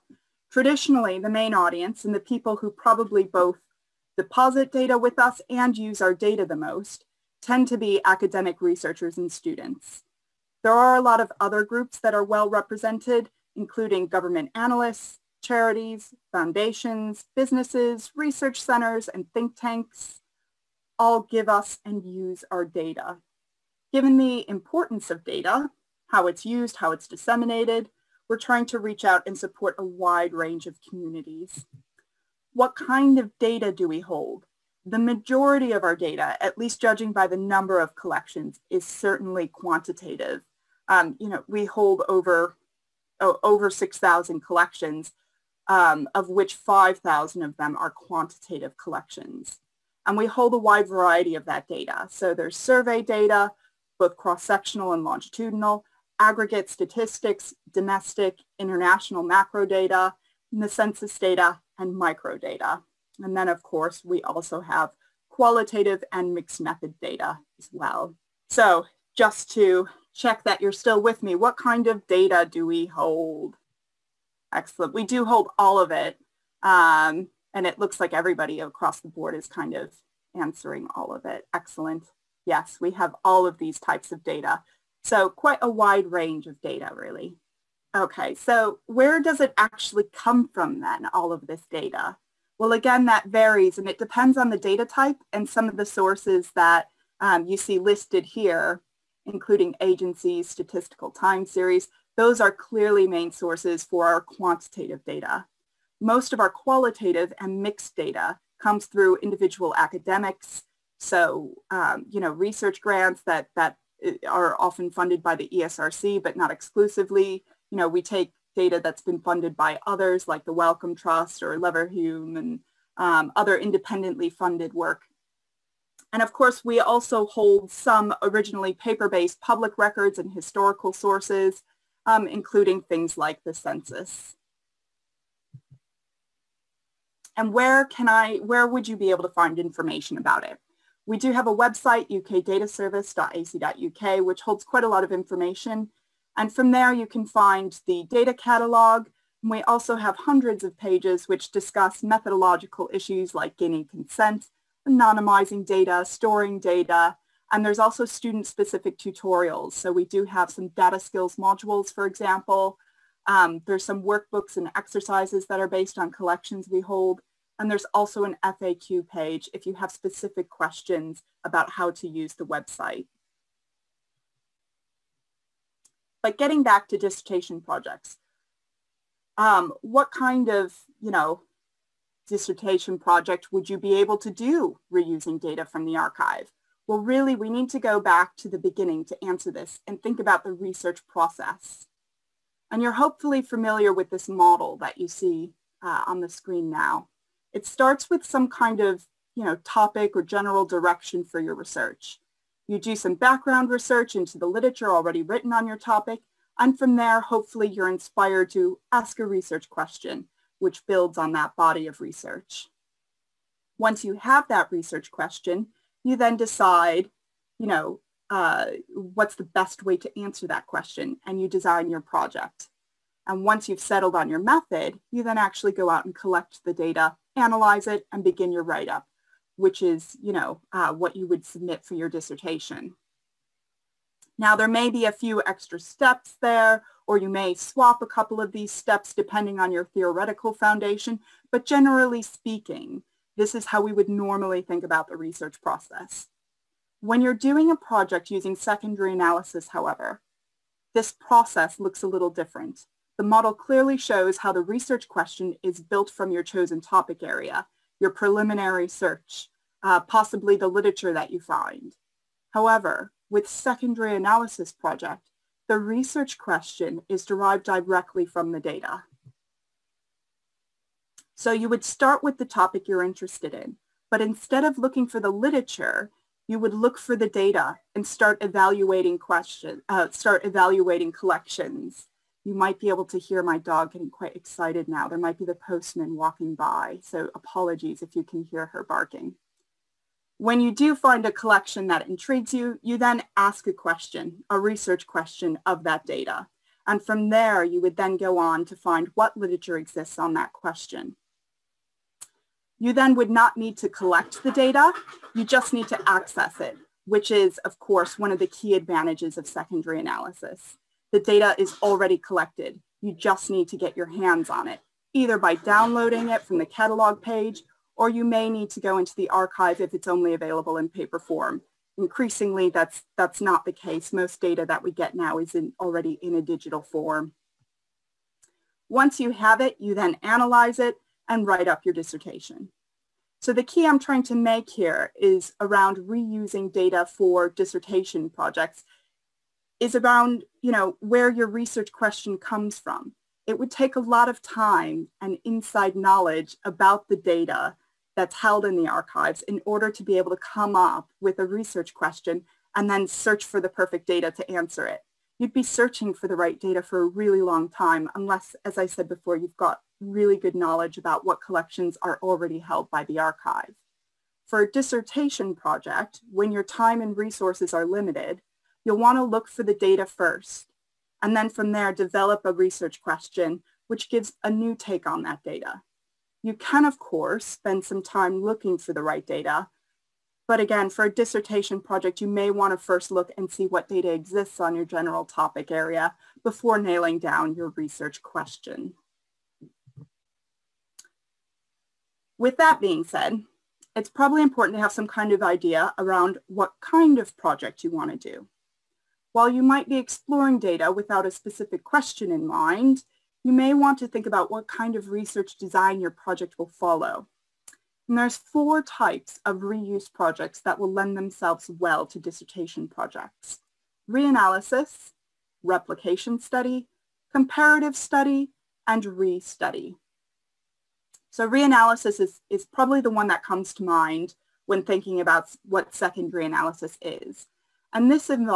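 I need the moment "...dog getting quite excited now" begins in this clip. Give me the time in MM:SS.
04:43.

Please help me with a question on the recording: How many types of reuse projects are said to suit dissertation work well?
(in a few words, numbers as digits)
4.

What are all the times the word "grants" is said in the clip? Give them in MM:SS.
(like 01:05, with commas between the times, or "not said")
01:52.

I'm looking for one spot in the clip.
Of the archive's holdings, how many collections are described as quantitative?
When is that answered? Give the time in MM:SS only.
00:46.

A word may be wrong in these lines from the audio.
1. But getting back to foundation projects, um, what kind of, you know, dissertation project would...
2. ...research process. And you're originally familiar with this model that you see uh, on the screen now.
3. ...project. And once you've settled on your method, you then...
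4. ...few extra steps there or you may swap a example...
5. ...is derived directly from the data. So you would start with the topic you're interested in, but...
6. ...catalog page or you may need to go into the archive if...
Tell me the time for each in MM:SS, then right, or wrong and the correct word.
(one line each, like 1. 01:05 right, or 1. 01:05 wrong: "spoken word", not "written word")
1. 02:56 wrong: "dissertation", not "foundation"
2. 03:10 wrong: "hopefully", not "originally"
3. 03:42 right
4. 03:55 wrong: "couple", not "example"
5. 04:27 right
6. 05:16 right.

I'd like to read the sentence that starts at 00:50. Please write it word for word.
And we hold a wide variety of that data.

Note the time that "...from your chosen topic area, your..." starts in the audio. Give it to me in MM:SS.
04:16.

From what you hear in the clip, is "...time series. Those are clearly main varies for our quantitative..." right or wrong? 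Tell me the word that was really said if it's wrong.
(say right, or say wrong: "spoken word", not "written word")
wrong: "sources", not "varies".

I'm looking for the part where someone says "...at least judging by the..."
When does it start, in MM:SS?
00:36.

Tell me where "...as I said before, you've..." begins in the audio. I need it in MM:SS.
05:58.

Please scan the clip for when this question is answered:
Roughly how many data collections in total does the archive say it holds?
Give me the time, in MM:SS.
00:43.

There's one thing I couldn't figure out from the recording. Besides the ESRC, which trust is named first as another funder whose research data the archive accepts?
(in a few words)
Wellcome Trust.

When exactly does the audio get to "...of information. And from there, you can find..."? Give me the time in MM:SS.
02:25.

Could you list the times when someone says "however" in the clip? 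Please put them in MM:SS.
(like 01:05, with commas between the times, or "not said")
04:09, 04:22.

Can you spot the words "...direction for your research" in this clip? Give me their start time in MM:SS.
03:20.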